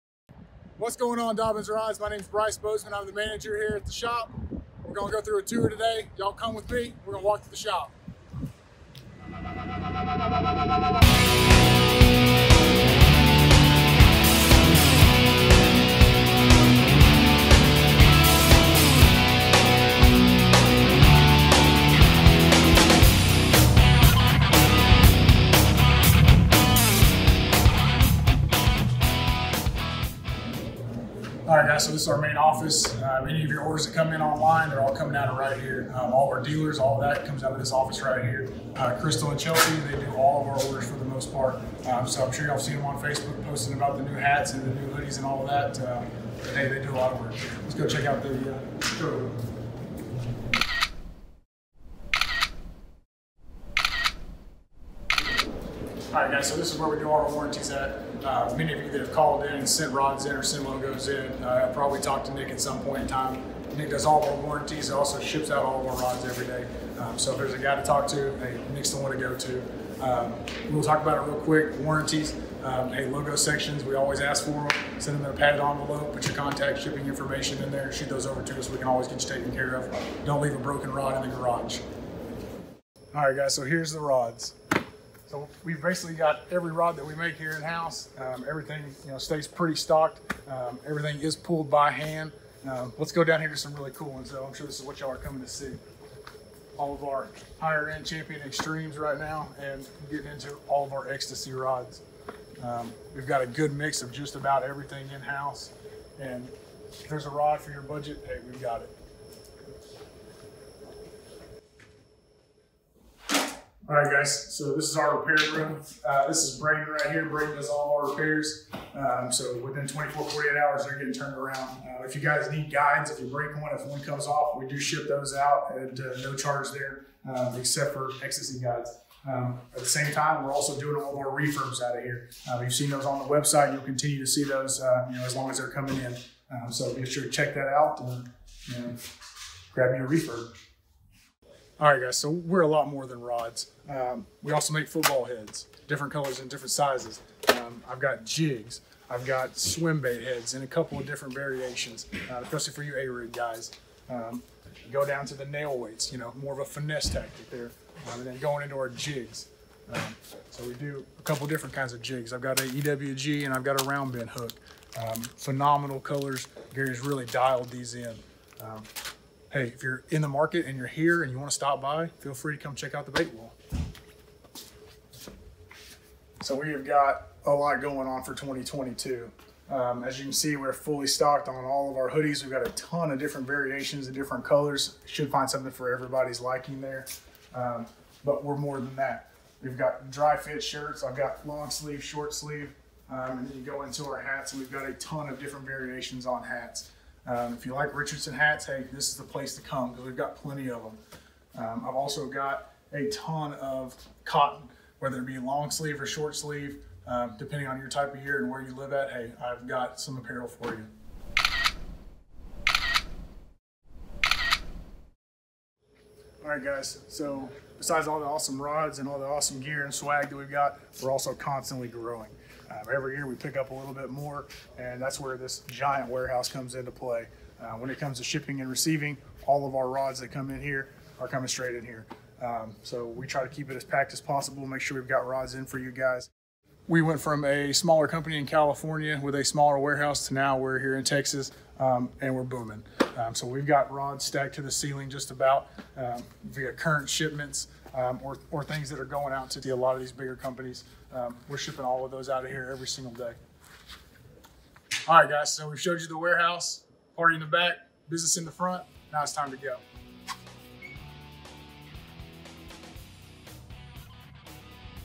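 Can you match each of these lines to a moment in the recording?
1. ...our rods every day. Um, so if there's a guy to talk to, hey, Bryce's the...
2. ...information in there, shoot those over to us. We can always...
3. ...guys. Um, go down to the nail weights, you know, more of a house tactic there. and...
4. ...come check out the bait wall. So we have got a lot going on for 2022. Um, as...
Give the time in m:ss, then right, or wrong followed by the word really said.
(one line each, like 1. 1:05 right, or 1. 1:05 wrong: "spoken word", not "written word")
1. 1:05 wrong: "Nick", not "Bryce"
2. 1:17 right
3. 2:33 wrong: "finesse", not "house"
4. 2:52 right.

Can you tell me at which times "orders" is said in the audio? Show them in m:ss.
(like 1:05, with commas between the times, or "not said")
0:33, 0:40.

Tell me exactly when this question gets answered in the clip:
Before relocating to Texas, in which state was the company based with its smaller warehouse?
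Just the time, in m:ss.
3:58.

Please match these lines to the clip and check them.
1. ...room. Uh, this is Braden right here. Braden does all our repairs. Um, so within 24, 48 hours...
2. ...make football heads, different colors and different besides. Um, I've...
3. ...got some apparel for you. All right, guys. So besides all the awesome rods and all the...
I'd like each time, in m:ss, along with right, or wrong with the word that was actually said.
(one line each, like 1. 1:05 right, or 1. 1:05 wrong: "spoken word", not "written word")
1. 1:55 right
2. 2:24 wrong: "sizes", not "besides"
3. 3:29 right.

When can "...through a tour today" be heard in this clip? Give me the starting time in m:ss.
0:05.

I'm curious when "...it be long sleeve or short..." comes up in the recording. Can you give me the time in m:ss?
3:25.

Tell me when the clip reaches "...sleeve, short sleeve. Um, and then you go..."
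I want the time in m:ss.
3:11.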